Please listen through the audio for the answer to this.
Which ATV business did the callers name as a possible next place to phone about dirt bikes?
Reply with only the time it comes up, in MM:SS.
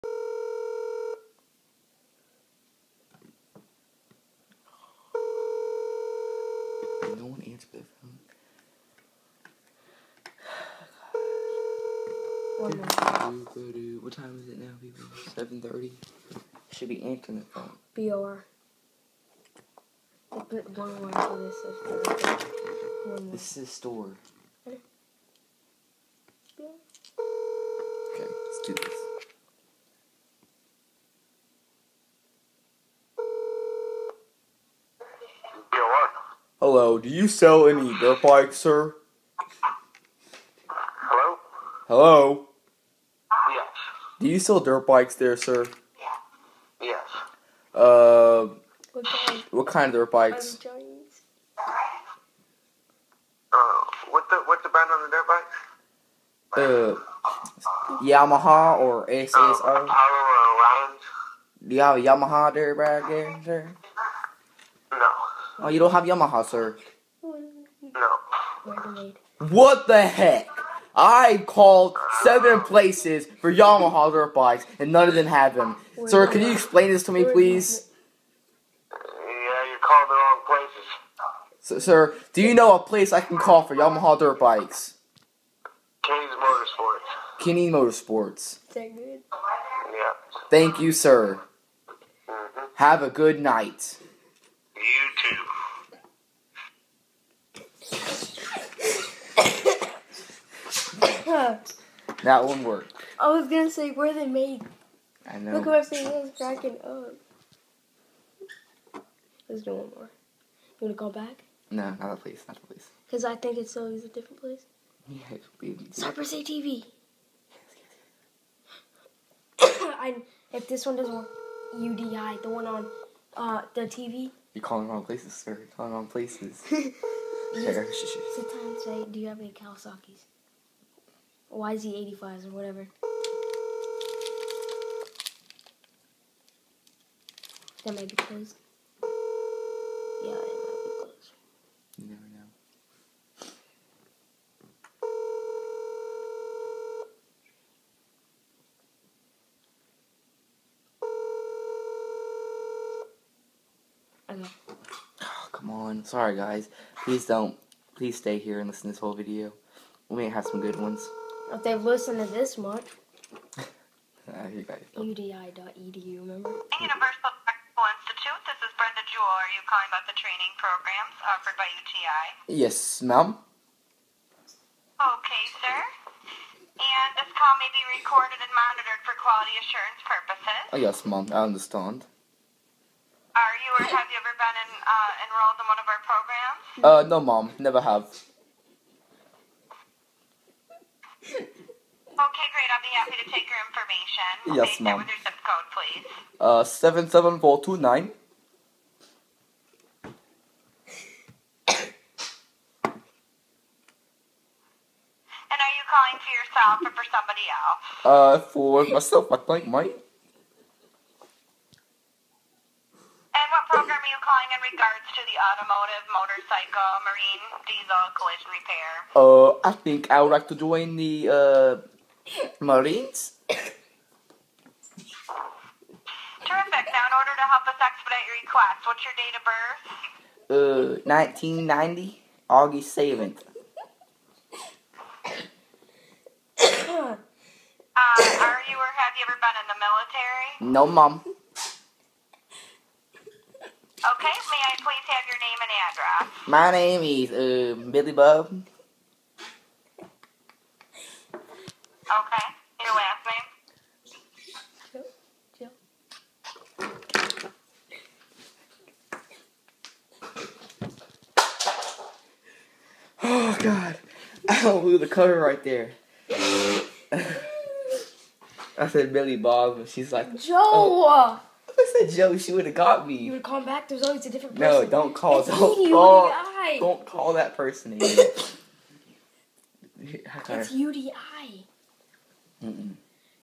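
01:55.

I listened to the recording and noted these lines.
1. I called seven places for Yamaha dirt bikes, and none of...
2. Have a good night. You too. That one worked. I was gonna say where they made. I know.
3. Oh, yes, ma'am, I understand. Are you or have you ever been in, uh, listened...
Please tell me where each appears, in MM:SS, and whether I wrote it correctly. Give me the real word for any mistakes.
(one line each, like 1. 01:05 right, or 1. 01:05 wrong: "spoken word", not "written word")
1. 01:10 right
2. 01:32 right
3. 03:00 wrong: "enrolled", not "listened".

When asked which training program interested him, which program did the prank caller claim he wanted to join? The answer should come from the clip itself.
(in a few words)
Marines.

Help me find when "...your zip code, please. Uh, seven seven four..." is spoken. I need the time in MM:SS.
03:15.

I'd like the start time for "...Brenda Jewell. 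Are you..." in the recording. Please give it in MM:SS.
02:48.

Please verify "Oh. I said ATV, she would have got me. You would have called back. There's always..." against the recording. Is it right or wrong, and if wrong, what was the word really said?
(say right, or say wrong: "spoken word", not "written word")
wrong: "Joe", not "ATV".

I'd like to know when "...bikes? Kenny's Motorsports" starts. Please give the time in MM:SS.
01:24.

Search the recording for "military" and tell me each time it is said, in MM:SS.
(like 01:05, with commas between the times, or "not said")
03:59.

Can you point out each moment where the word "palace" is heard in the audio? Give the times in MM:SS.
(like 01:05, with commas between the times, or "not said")
not said.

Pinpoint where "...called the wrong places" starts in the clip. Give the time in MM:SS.
01:19.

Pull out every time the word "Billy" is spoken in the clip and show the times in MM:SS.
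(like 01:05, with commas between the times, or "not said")
04:07, 04:29.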